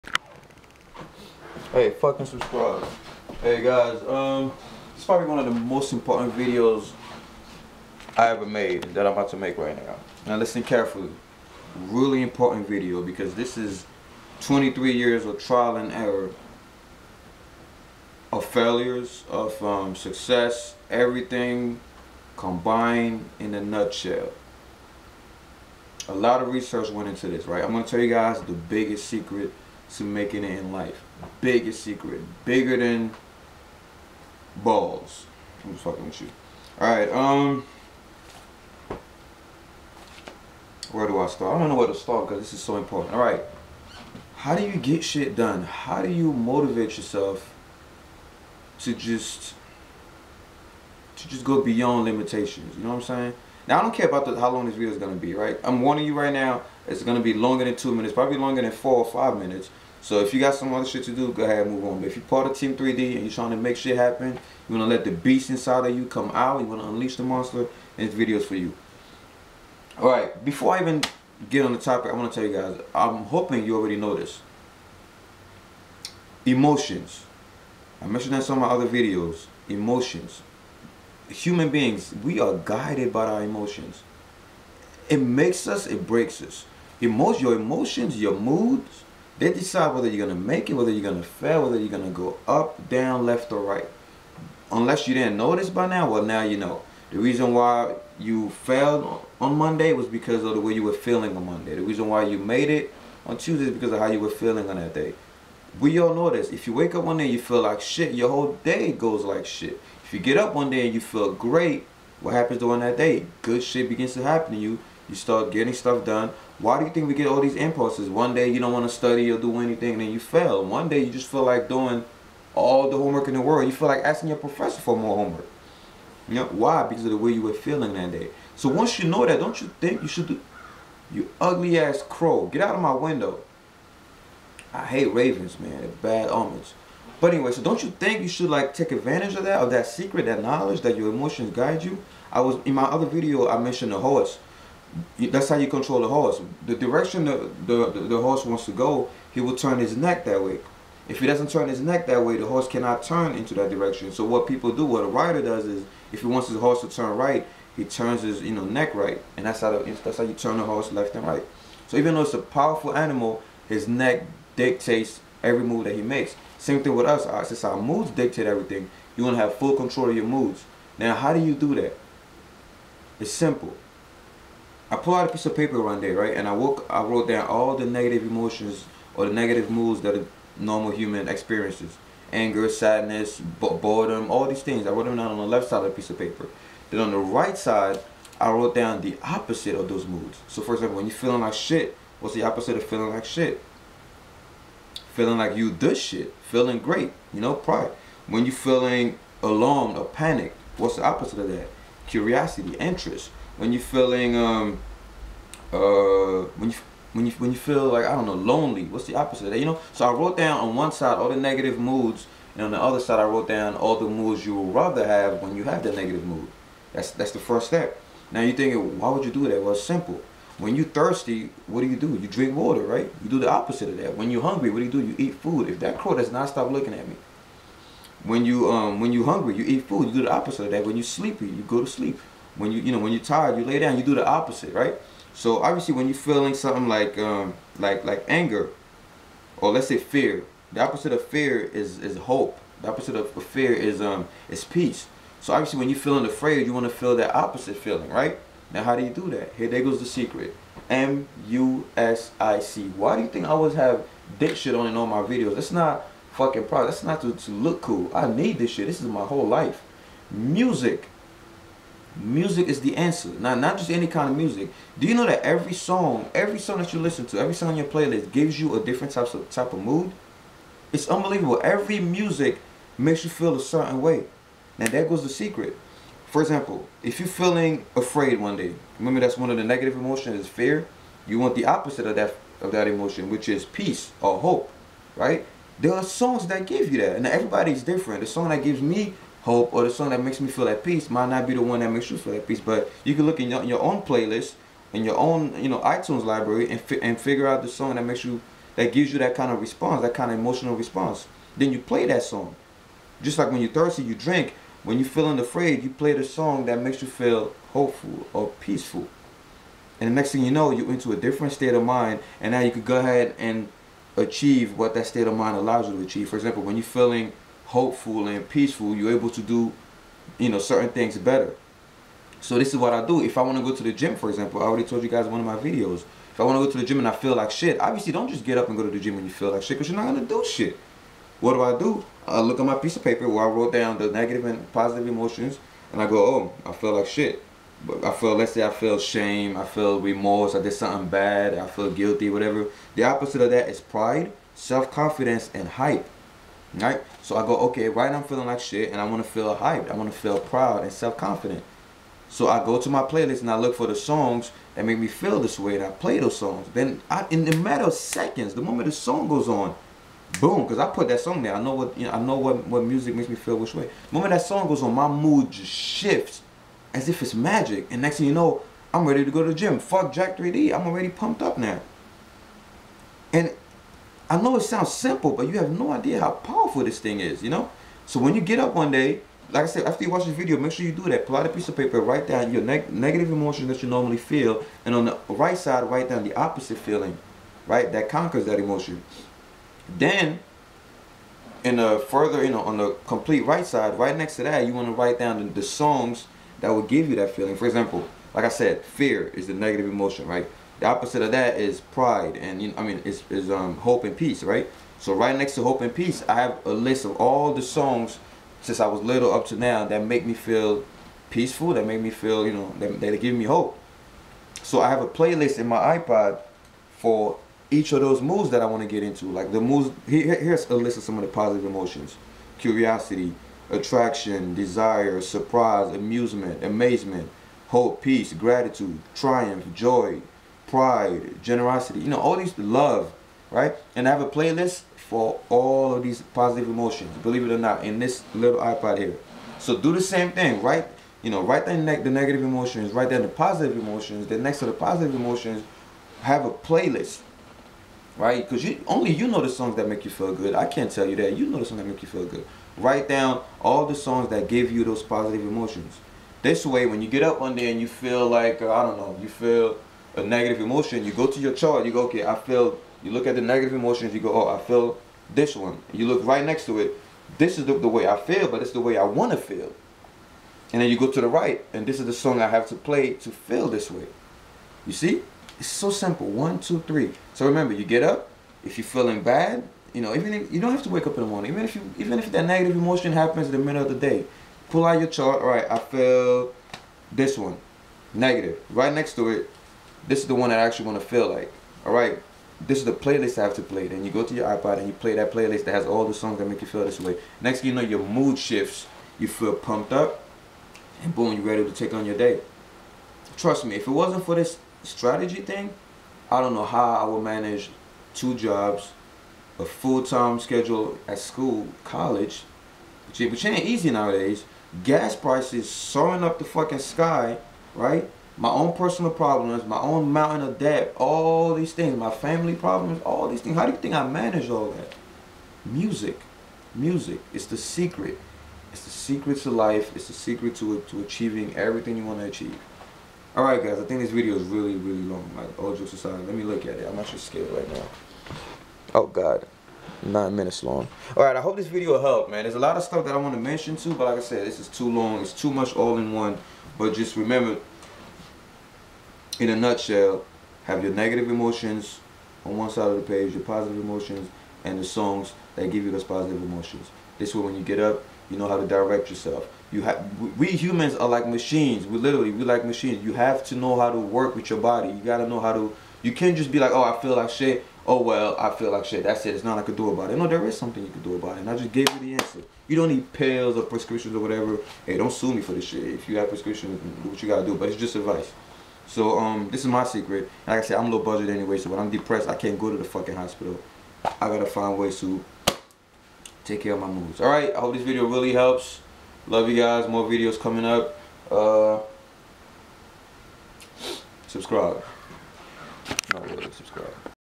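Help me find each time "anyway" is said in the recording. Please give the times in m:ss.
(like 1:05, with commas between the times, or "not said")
2:17, 9:41.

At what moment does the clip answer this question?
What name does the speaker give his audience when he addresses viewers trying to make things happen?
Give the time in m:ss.
1:02.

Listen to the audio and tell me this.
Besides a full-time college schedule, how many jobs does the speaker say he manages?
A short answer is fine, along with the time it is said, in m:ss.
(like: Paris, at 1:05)
2, at 8:28.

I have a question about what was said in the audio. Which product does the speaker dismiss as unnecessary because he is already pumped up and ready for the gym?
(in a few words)
Jack 3D.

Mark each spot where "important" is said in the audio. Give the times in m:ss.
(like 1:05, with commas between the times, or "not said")
0:05, 0:12, 0:42.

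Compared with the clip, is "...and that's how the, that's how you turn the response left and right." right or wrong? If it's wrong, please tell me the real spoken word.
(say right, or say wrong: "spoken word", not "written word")
wrong: "horse", not "response".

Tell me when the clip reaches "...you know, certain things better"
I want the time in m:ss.
5:20.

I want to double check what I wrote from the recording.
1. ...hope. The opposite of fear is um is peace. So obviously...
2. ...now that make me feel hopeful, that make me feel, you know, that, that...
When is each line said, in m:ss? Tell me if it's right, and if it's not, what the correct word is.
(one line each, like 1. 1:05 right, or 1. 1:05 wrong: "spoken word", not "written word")
1. 4:02 right
2. 6:49 wrong: "peaceful", not "hopeful".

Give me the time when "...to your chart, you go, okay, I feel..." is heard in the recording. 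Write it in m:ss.
7:41.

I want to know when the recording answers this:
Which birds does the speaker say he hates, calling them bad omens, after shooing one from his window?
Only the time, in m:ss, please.
2:15.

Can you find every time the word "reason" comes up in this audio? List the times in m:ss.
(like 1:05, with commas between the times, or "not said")
1:37, 1:41.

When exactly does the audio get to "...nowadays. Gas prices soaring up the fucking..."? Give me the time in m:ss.
8:33.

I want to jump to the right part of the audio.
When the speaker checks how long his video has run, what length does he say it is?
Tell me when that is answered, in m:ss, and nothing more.
9:00.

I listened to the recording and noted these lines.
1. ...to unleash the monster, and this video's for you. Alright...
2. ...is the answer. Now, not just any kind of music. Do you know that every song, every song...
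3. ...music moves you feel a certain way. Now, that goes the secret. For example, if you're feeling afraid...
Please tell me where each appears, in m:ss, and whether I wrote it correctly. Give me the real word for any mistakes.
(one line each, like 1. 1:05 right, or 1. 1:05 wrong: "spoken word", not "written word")
1. 1:06 right
2. 4:22 right
3. 4:31 wrong: "makes", not "moves".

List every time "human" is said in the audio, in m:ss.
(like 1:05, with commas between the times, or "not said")
1:21, 3:00, 9:20.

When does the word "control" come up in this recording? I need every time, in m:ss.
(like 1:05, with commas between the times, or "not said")
2:25, 2:49.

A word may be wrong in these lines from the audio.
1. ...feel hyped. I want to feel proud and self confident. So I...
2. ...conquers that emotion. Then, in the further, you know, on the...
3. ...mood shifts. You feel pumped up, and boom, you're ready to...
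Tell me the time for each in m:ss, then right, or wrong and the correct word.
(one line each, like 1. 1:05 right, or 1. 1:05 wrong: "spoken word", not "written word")
1. 5:49 right
2. 6:28 right
3. 8:18 right.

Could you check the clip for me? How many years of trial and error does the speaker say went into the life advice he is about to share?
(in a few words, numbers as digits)
23.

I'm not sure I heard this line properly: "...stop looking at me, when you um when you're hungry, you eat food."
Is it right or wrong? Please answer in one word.
right.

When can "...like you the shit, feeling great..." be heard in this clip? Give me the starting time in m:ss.
3:15.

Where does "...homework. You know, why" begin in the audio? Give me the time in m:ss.
2:05.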